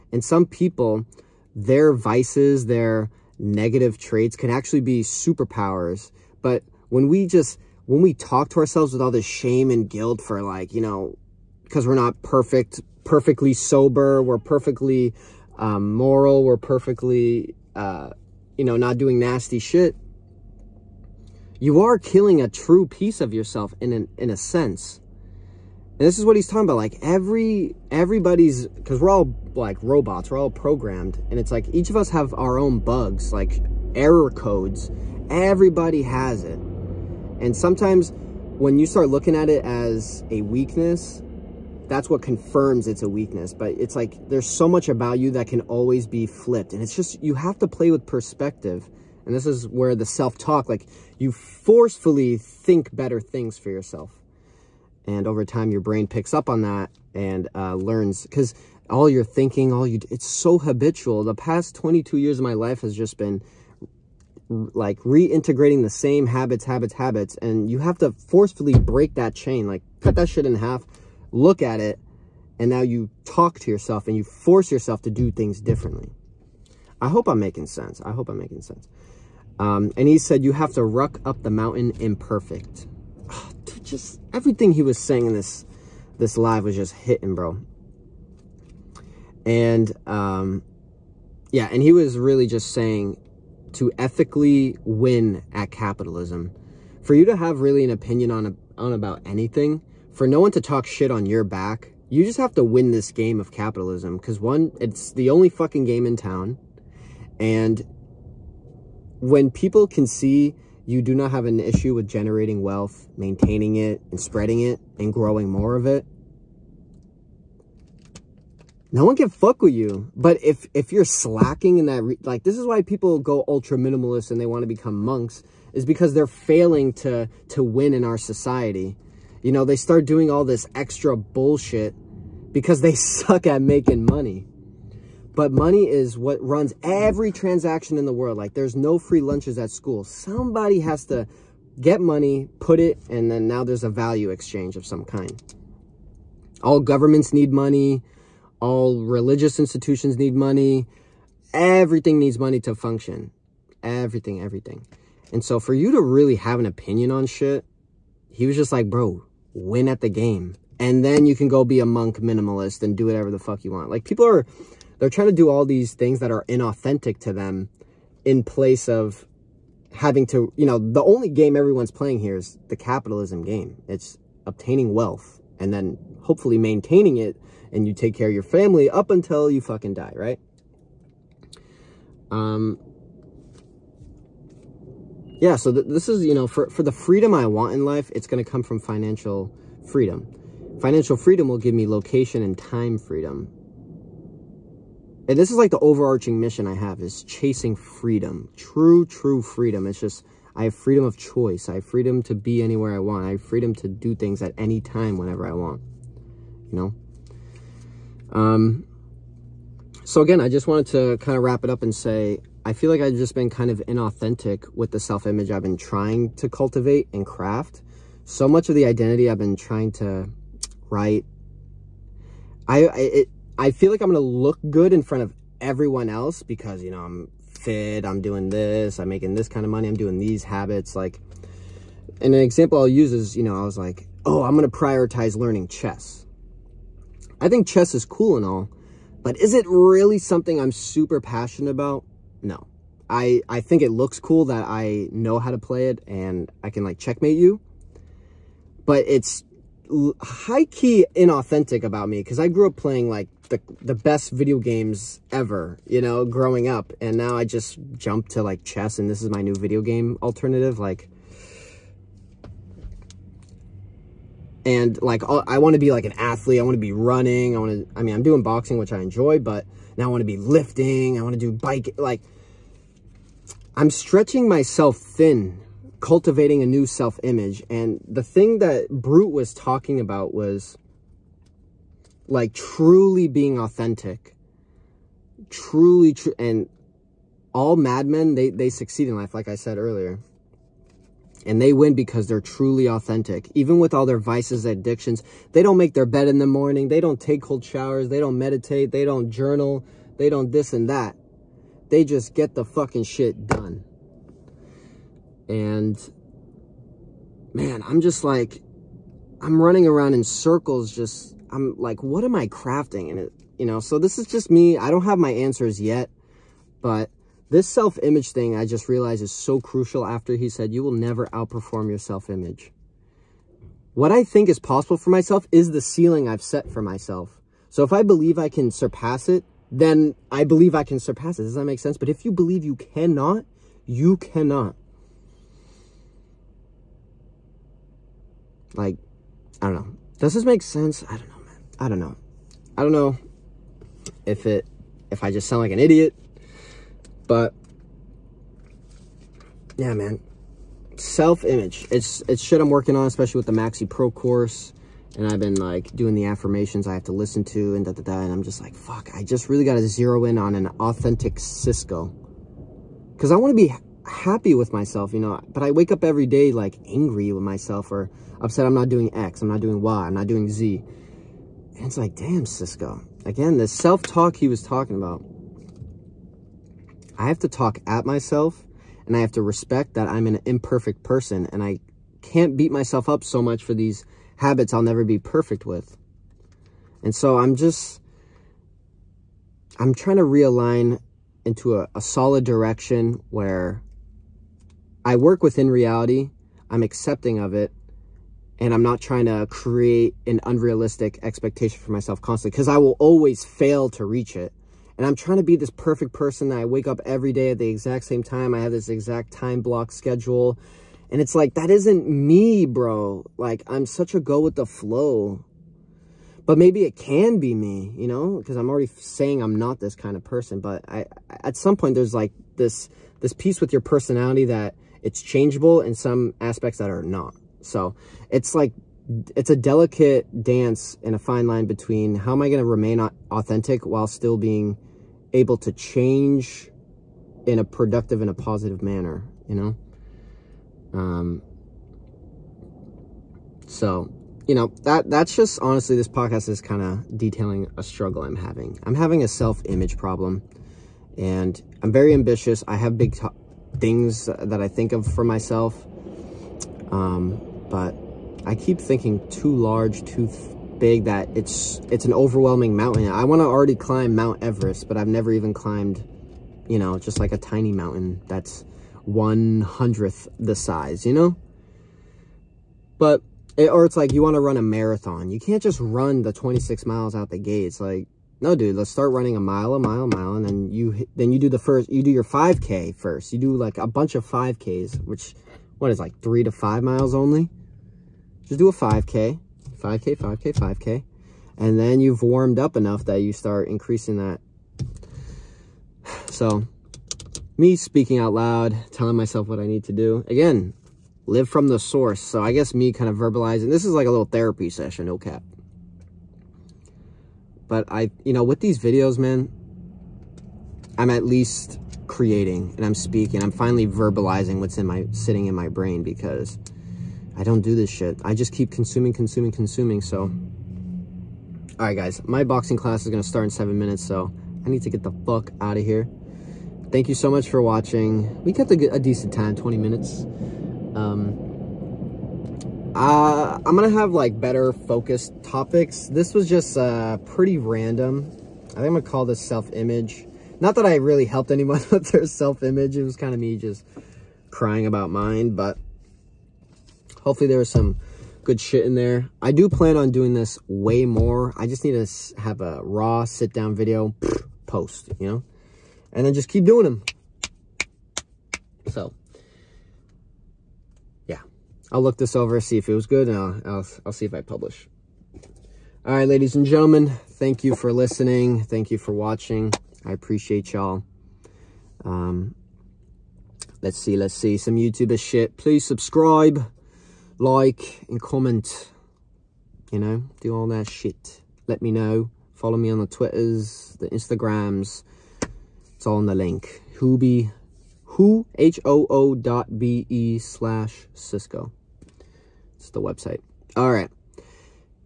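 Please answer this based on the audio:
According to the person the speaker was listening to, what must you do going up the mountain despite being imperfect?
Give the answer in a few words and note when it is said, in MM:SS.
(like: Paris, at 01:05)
Ruck, at 01:20.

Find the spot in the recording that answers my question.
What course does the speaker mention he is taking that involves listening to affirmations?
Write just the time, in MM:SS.
05:53.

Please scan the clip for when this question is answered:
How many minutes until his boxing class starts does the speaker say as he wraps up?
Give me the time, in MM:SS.
08:43.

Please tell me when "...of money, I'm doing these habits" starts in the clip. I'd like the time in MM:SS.
03:49.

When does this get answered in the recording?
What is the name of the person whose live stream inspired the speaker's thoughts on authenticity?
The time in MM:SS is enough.
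04:38.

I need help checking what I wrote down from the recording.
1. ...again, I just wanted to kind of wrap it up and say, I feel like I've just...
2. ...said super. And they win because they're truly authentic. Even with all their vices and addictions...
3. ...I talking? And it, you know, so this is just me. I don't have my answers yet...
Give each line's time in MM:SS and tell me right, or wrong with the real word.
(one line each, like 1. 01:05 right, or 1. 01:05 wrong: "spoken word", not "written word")
1. 03:30 right
2. 04:49 wrong: "earlier", not "super"
3. 05:12 wrong: "crafting", not "talking".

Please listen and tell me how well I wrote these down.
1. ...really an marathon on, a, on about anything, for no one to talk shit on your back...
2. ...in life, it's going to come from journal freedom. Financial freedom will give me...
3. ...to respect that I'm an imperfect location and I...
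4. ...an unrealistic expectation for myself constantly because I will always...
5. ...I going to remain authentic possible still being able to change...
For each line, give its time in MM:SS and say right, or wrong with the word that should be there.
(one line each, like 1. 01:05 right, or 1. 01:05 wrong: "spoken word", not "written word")
1. 01:37 wrong: "opinion", not "marathon"
2. 03:07 wrong: "financial", not "journal"
3. 06:19 wrong: "person", not "location"
4. 06:40 right
5. 07:12 wrong: "while", not "possible".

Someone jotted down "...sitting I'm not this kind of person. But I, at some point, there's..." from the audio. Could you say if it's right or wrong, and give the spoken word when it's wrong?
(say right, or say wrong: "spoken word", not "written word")
wrong: "saying", not "sitting".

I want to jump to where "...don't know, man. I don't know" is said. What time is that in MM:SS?
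05:41.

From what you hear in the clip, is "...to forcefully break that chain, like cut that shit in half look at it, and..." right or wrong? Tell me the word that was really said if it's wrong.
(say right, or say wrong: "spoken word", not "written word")
right.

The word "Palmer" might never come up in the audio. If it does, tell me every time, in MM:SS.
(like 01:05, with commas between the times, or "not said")
not said.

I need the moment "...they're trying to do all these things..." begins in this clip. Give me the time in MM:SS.
02:44.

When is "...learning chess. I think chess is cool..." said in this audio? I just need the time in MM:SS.
03:55.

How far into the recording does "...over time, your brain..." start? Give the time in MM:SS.
00:55.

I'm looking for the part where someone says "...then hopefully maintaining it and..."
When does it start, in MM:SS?
02:55.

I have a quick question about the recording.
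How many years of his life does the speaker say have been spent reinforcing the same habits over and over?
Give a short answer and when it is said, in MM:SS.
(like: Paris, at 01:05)
22, at 01:01.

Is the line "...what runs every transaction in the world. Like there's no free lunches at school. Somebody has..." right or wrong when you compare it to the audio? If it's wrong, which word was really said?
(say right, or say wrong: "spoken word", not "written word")
right.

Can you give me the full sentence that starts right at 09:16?
And then just keep doing them.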